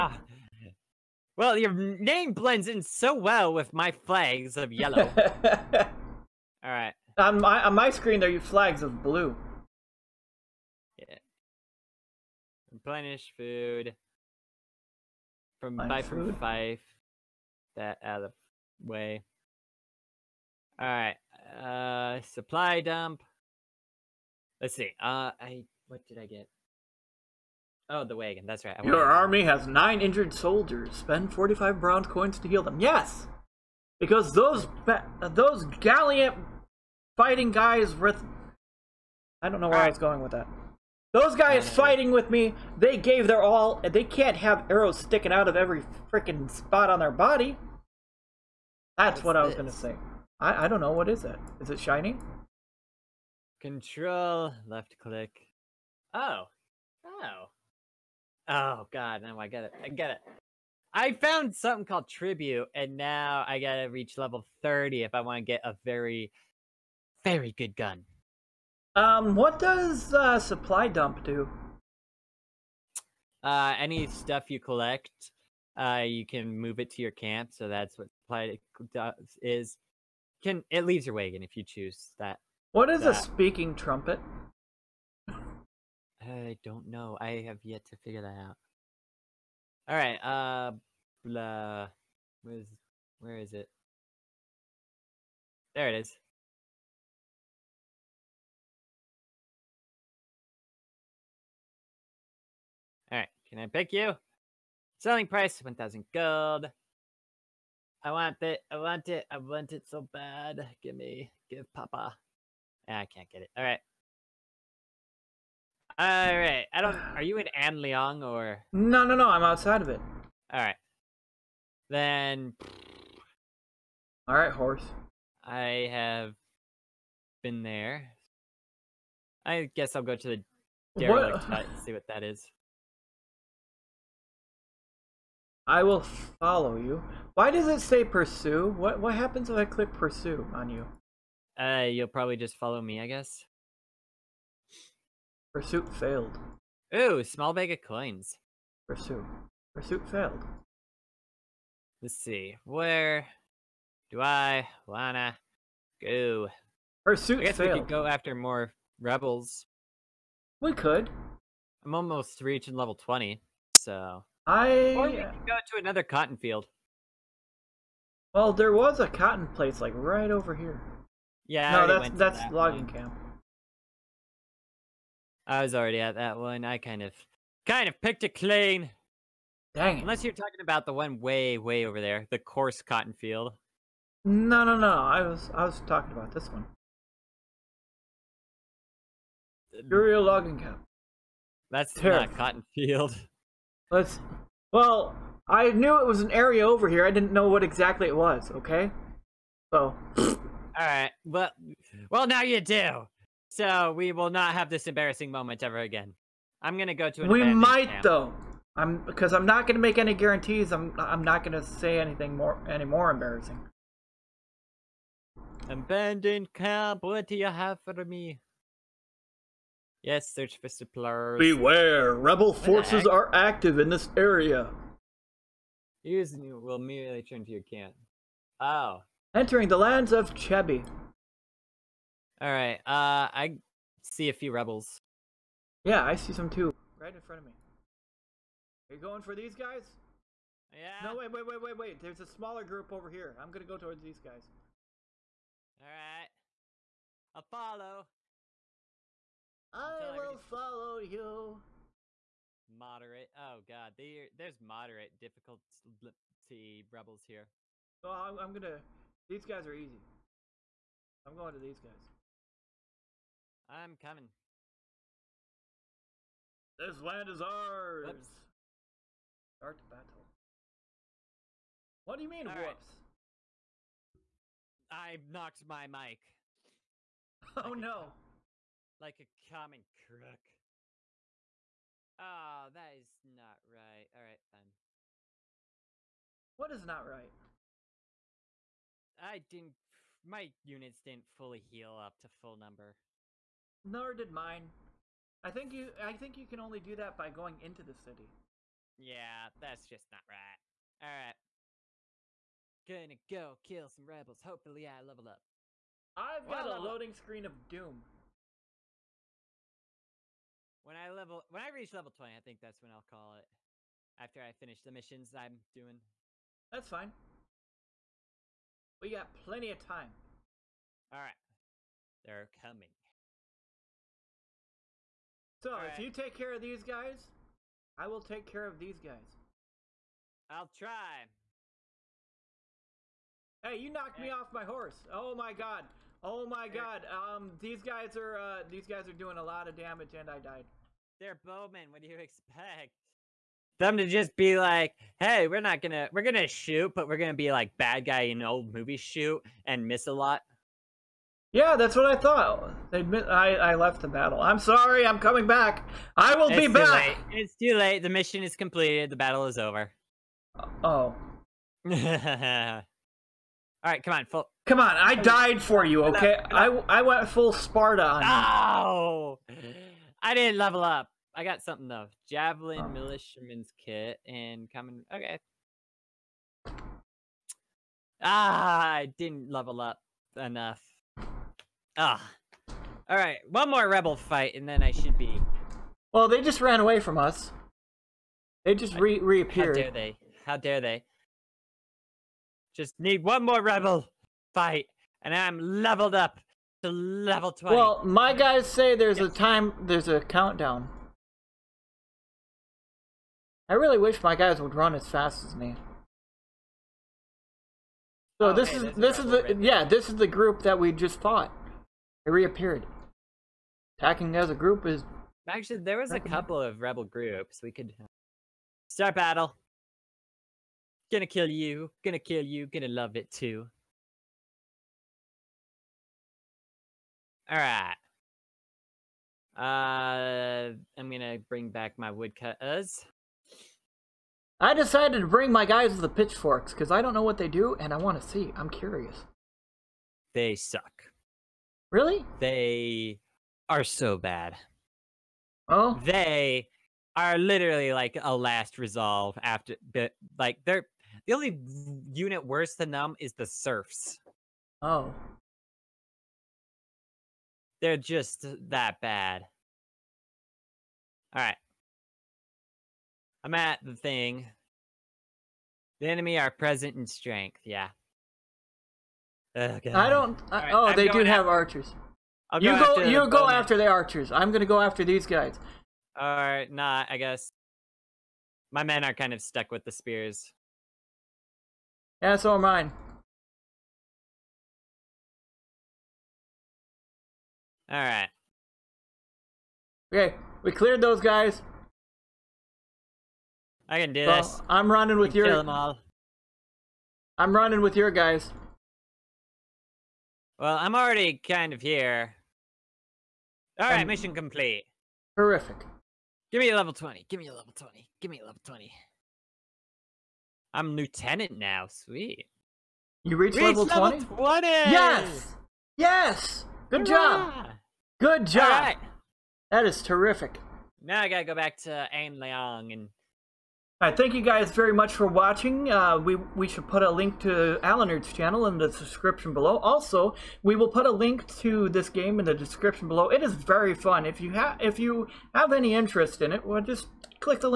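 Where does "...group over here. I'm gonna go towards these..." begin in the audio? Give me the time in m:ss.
4:02.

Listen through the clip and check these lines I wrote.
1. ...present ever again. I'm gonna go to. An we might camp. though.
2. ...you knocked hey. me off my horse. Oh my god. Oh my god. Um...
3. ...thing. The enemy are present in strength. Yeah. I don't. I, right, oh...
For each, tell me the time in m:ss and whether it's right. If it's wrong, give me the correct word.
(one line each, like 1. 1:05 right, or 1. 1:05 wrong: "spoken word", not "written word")
1. 3:25 wrong: "moment", not "present"
2. 5:33 right
3. 7:43 right.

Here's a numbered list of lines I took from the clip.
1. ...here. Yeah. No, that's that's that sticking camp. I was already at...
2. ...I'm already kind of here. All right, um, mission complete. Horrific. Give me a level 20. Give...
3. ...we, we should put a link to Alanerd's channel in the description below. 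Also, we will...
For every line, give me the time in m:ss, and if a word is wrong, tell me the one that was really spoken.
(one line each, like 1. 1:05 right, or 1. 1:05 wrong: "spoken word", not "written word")
1. 2:50 wrong: "logging", not "sticking"
2. 8:20 right
3. 8:46 right.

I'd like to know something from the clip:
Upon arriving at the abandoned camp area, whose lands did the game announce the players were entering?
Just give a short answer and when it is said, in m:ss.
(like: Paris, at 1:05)
Chebi, at 3:50.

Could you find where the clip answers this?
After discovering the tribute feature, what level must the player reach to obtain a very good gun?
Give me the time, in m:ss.
1:04.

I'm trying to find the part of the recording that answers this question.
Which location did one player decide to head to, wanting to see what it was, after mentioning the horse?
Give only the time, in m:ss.
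2:10.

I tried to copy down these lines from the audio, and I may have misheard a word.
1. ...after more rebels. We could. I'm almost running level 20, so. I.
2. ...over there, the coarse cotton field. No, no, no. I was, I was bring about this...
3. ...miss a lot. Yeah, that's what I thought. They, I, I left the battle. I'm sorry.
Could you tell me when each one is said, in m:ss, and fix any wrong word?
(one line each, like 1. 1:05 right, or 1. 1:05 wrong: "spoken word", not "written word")
1. 2:38 wrong: "reaching", not "running"
2. 3:01 wrong: "talking", not "bring"
3. 5:49 right.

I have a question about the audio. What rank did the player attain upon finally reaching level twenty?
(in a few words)
lieutenant.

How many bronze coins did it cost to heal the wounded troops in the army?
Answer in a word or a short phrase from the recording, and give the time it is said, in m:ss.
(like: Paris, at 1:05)
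45, at 0:31.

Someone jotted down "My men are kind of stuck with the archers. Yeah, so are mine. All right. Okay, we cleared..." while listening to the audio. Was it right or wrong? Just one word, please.
wrong.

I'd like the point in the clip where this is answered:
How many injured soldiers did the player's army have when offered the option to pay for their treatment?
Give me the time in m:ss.
0:29.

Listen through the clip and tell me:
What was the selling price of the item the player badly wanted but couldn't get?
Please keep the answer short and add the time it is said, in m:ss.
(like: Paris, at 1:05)
1000 gold, at 1:45.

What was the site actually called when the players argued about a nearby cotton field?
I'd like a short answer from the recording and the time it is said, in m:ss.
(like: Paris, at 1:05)
Burial logging camp, at 3:09.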